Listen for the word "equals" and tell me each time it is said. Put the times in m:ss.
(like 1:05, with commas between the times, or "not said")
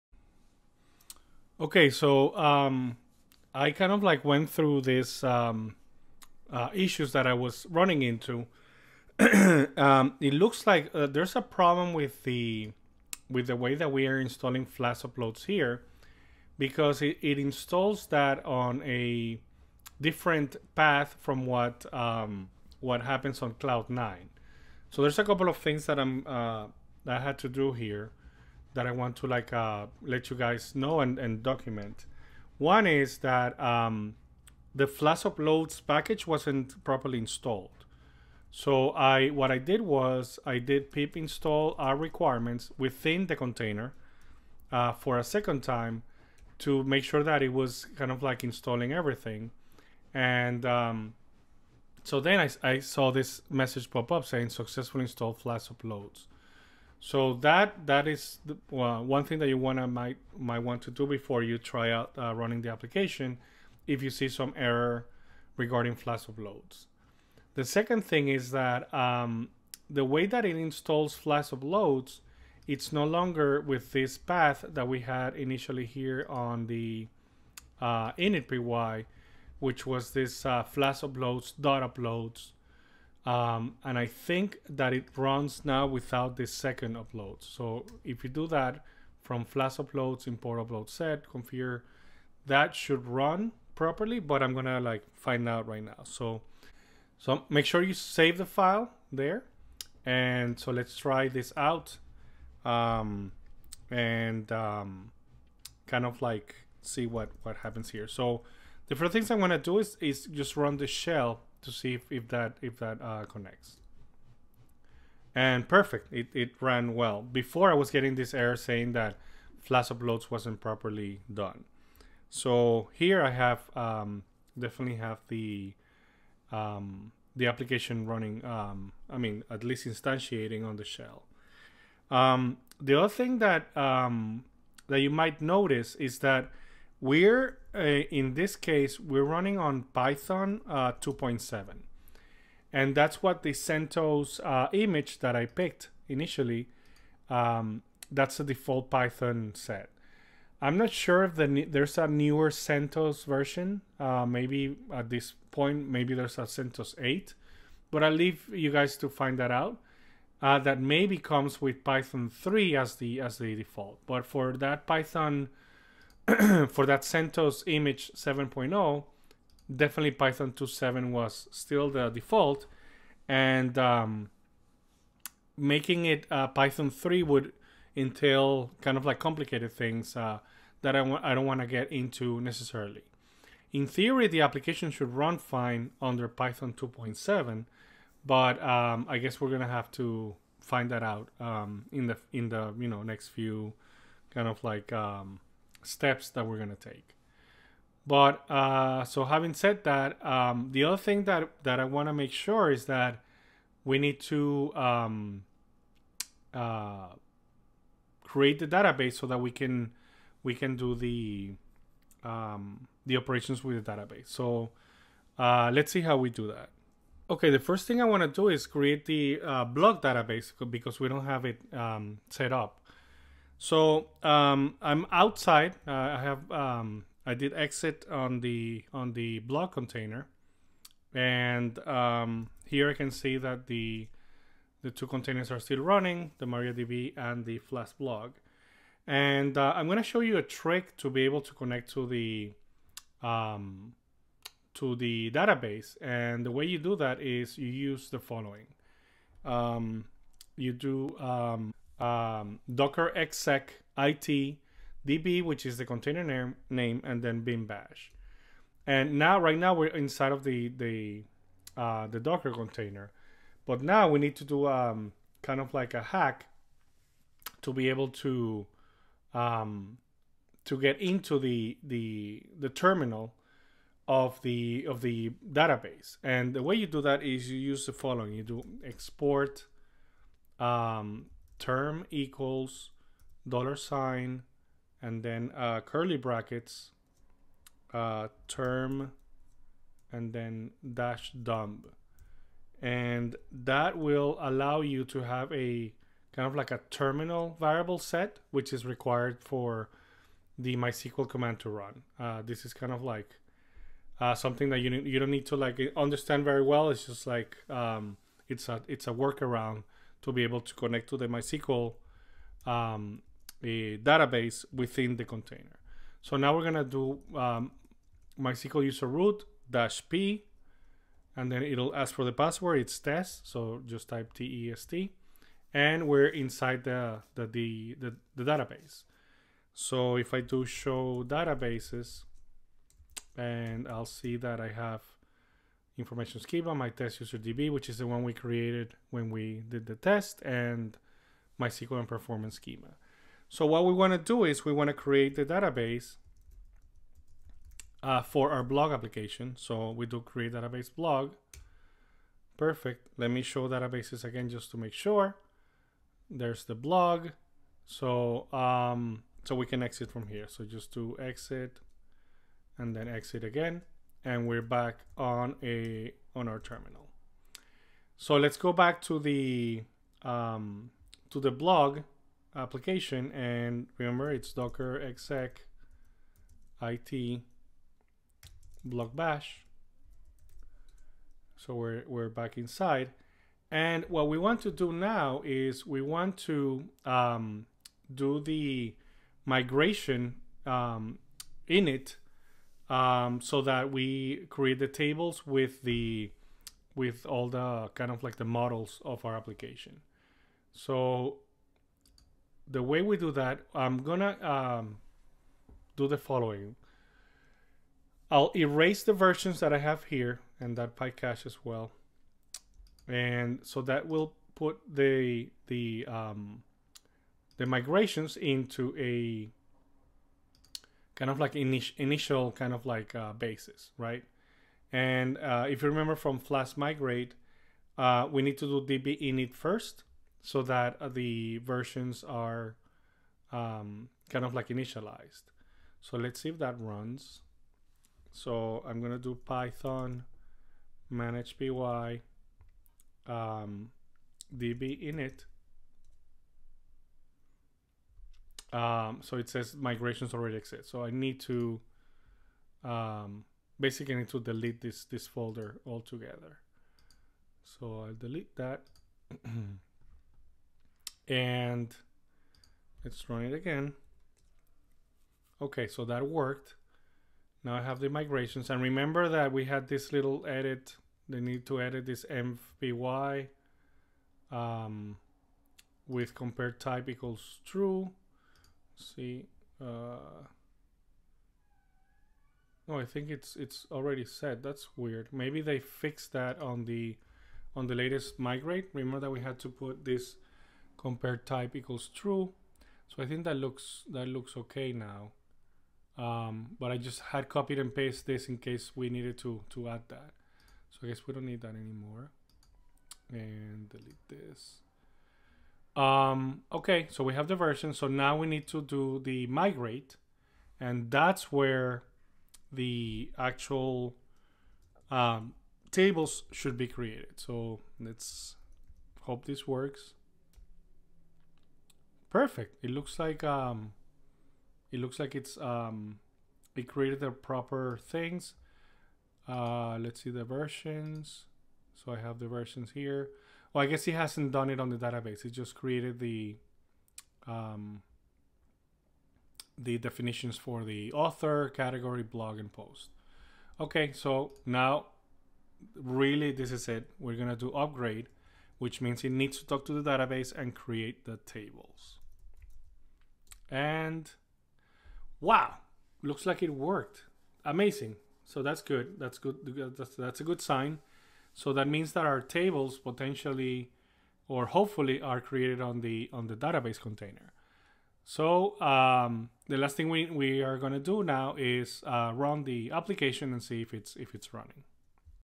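4:42, 7:57, 8:11.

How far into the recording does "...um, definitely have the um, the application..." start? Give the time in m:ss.
2:03.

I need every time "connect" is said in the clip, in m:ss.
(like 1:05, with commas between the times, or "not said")
1:53, 4:01, 5:10.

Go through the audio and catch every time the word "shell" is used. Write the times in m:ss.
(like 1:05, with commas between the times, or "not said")
1:50, 2:10.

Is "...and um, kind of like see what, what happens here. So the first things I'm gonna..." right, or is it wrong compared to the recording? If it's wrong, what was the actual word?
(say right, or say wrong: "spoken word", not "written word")
right.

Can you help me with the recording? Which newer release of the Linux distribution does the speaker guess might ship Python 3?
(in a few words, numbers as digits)
CentOS 8.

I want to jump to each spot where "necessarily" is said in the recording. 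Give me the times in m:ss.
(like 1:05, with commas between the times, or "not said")
3:02.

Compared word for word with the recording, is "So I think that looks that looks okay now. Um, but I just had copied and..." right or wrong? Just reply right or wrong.
right.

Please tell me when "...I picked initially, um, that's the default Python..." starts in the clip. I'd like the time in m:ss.
2:25.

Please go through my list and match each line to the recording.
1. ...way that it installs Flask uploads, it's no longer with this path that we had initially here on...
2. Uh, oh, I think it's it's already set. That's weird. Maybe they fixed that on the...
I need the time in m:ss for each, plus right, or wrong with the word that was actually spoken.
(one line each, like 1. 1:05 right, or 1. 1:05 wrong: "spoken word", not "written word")
1. 1:10 right
2. 7:59 right.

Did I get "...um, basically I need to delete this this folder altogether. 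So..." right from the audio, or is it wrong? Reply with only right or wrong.
right.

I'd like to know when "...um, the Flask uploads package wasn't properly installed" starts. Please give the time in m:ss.
0:33.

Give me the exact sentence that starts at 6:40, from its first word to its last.
So the way we do that, I'm gonna um, do the following.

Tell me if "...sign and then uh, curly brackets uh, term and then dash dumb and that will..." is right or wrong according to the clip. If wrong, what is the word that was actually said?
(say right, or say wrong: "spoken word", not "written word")
right.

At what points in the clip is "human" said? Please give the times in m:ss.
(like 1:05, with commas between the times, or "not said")
not said.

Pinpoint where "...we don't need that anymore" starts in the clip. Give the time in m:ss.
8:21.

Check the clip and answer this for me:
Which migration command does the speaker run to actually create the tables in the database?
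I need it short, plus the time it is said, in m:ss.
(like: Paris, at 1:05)
upgrade, at 9:07.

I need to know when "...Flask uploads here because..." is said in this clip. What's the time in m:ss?
0:14.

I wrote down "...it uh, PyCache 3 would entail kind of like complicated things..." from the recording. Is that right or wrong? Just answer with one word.
wrong.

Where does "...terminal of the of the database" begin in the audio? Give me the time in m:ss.
4:32.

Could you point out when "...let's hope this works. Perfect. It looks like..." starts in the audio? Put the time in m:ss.
8:37.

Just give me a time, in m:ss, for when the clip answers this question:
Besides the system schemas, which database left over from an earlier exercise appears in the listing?
5:36.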